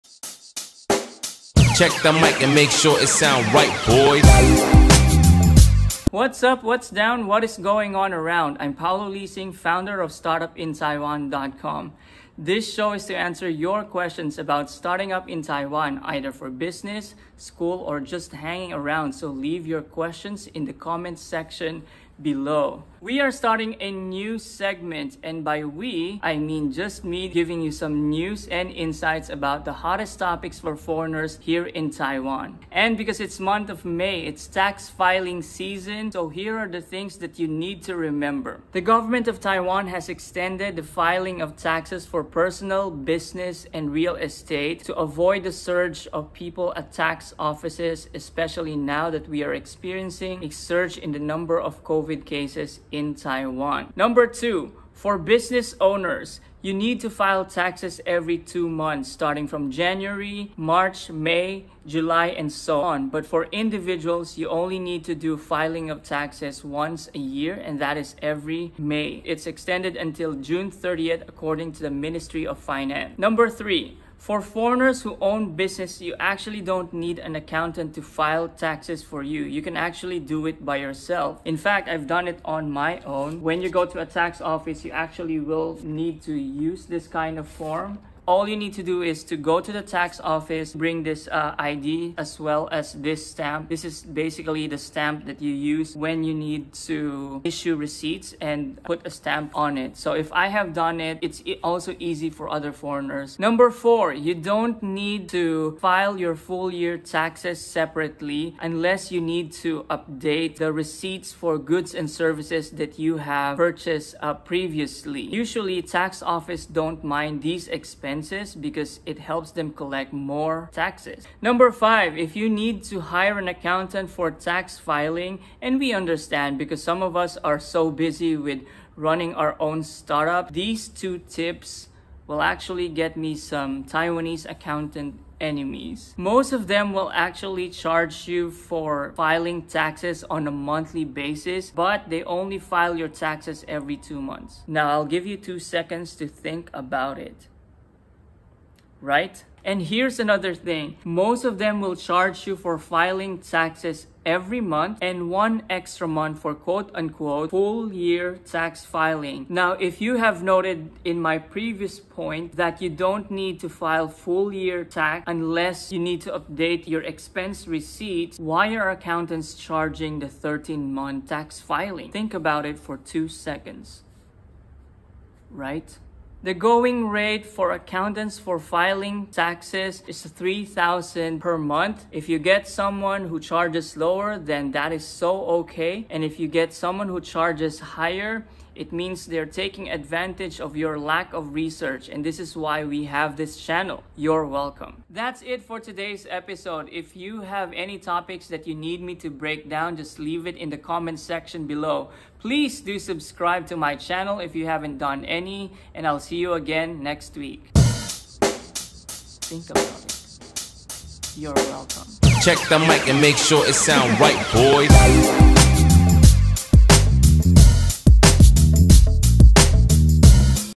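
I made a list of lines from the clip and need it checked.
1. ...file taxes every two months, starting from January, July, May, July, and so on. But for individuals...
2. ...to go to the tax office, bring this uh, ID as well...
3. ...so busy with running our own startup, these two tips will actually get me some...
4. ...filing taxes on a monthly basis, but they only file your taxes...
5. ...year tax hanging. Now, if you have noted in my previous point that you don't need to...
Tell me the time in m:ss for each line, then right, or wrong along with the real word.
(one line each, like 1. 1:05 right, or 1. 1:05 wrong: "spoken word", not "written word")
1. 0:57 wrong: "March", not "July"
2. 1:29 right
3. 2:07 right
4. 2:19 right
5. 2:37 wrong: "filing", not "hanging".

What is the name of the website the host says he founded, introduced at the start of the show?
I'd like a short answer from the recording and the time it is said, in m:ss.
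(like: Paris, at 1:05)
StartupInTaiwan.com, at 0:10.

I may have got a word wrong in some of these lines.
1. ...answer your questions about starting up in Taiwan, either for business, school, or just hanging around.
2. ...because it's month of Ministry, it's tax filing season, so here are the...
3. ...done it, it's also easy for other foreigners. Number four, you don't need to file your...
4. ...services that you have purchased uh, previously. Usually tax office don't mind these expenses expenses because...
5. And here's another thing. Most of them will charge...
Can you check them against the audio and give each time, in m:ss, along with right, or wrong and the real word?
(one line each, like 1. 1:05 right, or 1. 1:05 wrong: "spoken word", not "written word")
1. 0:13 right
2. 0:32 wrong: "May", not "Ministry"
3. 1:40 right
4. 1:52 right
5. 2:29 right.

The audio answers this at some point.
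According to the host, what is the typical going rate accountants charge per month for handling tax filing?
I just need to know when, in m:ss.
3:00.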